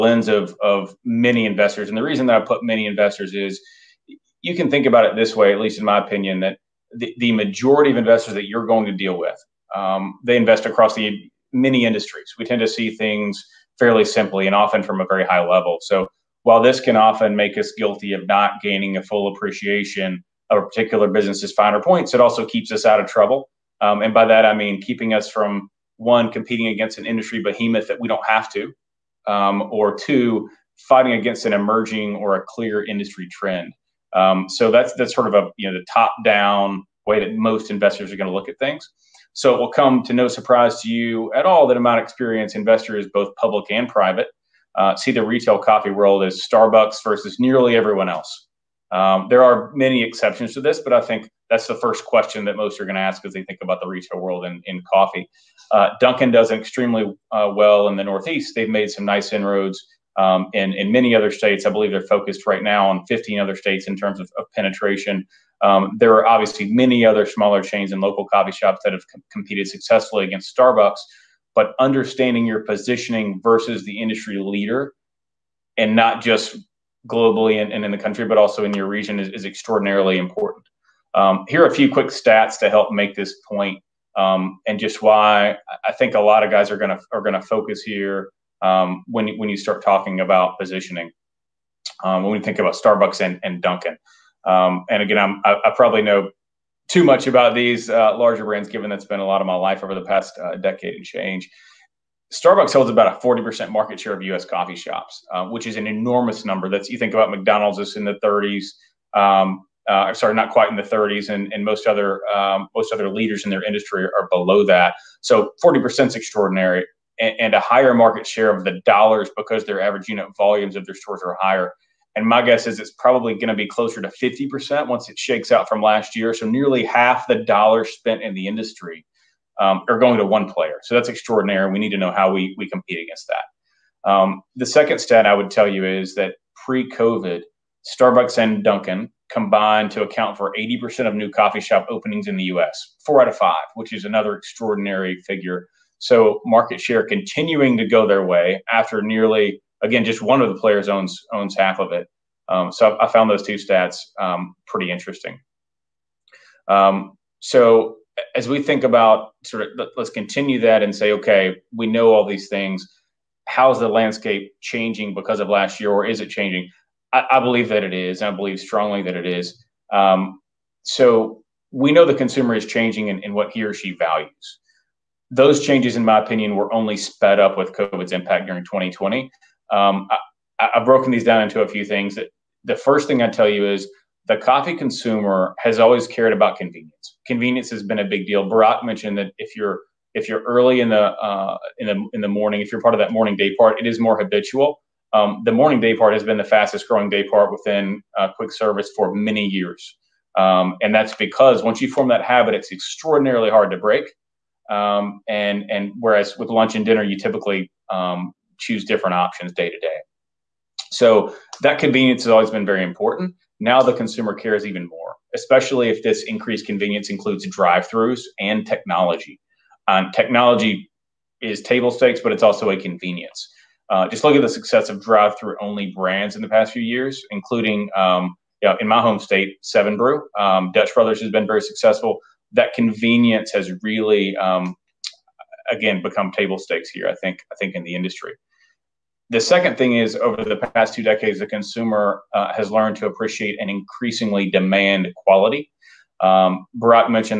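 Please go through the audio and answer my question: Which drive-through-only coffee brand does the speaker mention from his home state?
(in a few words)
Seven Brew.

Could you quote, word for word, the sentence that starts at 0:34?
Um, so that's that's sort of a you know the top down way that most investors are going to look at things.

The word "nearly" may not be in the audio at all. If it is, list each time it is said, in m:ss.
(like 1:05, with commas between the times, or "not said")
0:47, 2:06, 2:29.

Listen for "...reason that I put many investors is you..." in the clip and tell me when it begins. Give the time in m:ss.
0:02.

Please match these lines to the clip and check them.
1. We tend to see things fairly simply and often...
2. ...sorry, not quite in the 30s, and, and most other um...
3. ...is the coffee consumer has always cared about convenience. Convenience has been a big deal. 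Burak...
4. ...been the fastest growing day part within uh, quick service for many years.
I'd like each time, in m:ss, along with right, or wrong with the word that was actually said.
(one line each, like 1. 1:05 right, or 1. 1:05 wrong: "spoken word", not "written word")
1. 0:12 right
2. 1:50 right
3. 3:03 right
4. 3:16 right.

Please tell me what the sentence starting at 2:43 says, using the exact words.
How is the landscape changing because of last year, or is it changing?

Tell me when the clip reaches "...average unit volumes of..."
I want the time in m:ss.
1:59.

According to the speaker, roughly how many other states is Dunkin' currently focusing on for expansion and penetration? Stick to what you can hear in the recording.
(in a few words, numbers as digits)
15.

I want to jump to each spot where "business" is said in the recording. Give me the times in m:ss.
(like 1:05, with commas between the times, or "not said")
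0:21.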